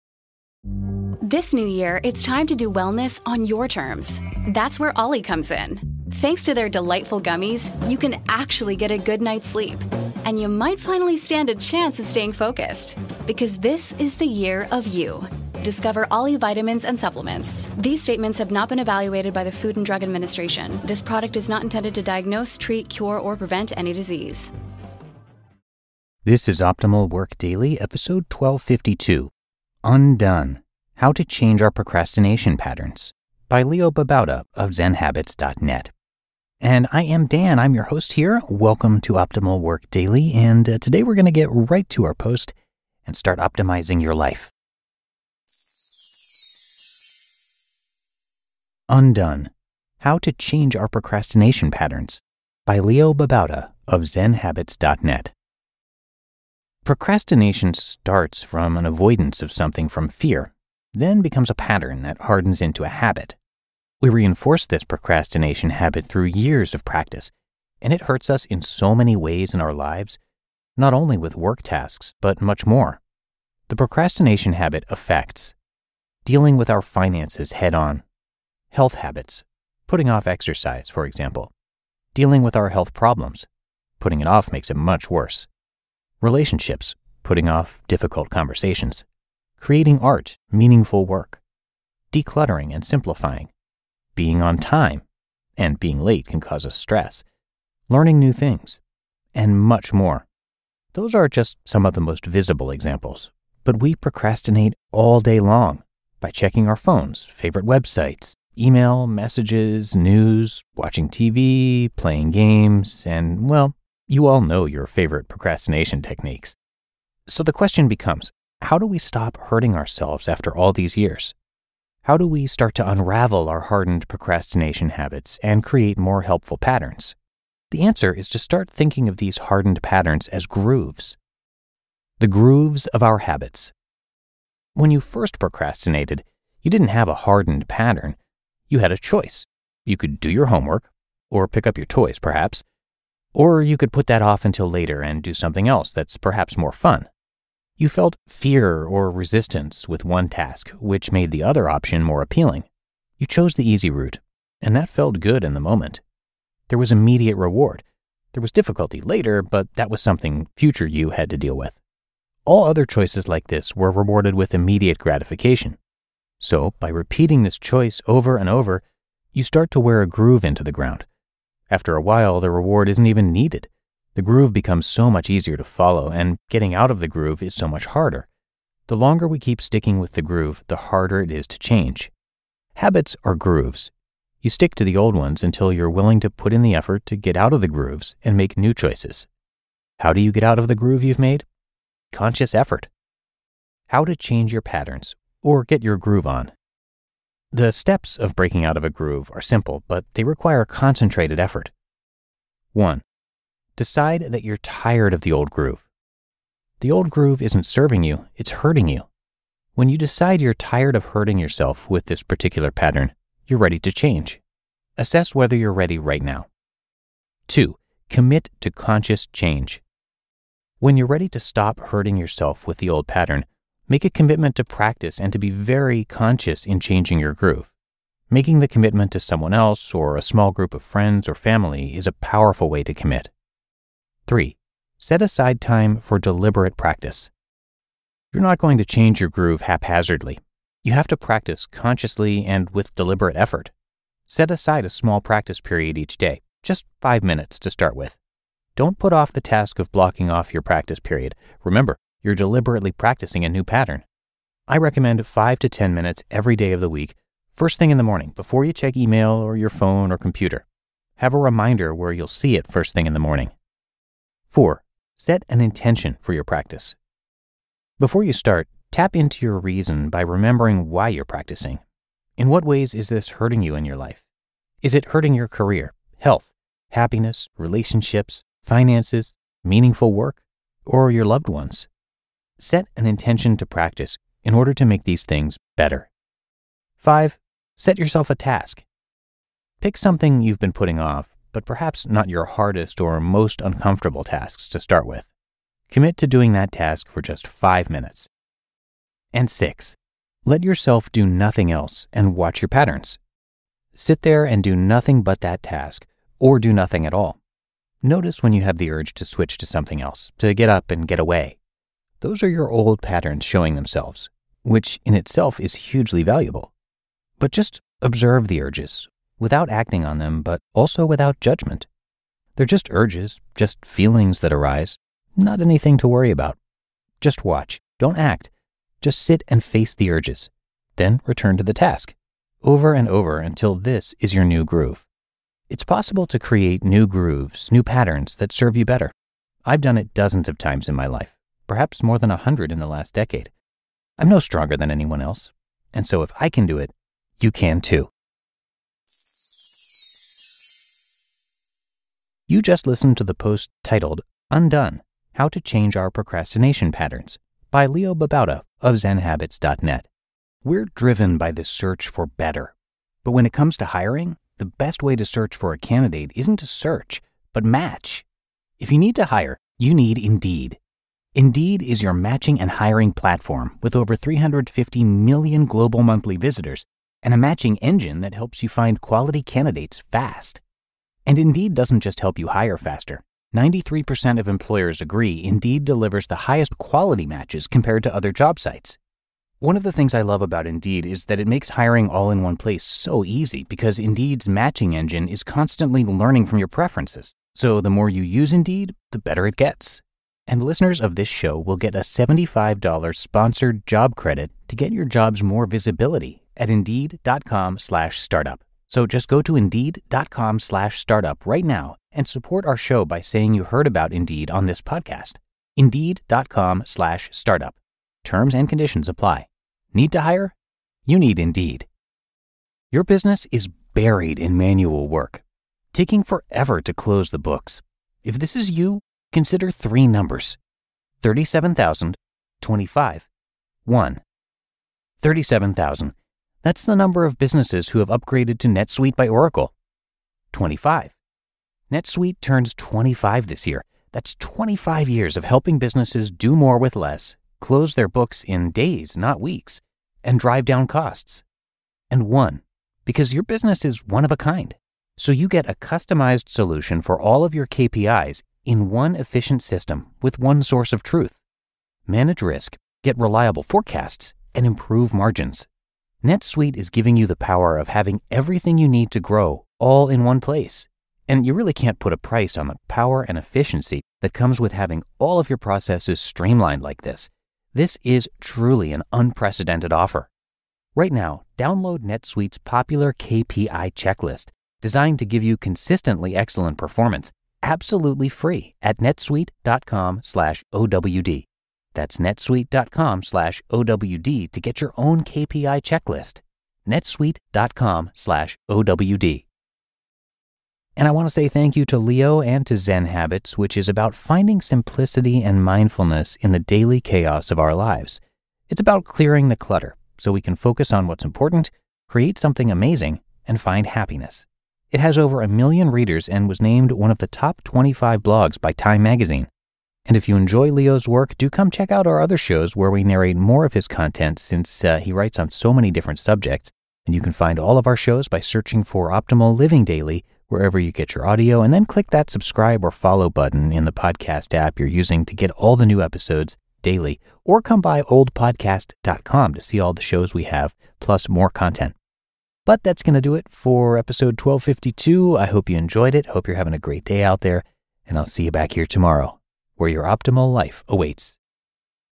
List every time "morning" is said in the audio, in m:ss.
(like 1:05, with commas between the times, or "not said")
4:18, 4:23.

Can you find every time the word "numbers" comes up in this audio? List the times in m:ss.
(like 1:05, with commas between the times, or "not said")
7:10, 7:16.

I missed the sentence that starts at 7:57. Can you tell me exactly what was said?
This is truly an unprecedented offer.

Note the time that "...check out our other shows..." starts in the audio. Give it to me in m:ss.
8:41.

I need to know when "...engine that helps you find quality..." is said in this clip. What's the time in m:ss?
6:17.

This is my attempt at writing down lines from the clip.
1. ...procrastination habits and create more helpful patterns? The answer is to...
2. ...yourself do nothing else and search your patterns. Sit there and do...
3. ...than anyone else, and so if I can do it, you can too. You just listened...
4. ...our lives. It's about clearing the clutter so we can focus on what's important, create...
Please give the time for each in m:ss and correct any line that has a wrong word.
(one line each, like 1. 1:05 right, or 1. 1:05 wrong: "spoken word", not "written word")
1. 2:04 right
2. 5:00 wrong: "watch", not "search"
3. 5:44 right
4. 8:27 right.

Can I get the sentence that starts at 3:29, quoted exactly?
When you decide you're tired of hurting yourself with this particular pattern, you're ready to change.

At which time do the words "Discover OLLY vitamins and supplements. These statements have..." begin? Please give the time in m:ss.
0:15.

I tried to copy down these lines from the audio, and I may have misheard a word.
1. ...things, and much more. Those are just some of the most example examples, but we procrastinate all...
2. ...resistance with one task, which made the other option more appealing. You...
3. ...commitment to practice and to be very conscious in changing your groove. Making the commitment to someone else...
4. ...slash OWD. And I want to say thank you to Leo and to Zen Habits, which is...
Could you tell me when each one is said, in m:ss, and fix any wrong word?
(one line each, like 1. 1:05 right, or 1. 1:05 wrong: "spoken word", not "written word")
1. 1:38 wrong: "visible", not "example"
2. 2:29 right
3. 3:44 right
4. 8:18 right.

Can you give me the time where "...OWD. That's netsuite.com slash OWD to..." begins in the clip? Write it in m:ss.
8:10.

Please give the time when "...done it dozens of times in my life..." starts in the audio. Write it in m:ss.
5:39.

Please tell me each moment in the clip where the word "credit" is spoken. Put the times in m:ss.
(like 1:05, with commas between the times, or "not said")
6:44.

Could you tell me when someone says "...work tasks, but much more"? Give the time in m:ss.
1:11.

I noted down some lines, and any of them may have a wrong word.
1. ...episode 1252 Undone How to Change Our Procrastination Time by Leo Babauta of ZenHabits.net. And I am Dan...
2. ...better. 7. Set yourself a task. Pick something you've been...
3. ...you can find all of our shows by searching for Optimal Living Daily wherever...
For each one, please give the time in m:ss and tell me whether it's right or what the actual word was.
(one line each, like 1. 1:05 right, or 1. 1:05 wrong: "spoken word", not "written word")
1. 0:27 wrong: "Patterns", not "Time"
2. 4:45 wrong: "5", not "7"
3. 8:47 right.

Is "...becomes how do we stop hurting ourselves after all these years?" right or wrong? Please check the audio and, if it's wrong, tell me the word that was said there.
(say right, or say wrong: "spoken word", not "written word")
right.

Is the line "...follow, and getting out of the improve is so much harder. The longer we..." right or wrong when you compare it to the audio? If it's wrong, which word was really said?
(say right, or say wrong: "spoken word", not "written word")
wrong: "groove", not "improve".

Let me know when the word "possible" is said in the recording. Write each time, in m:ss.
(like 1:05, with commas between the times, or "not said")
5:35.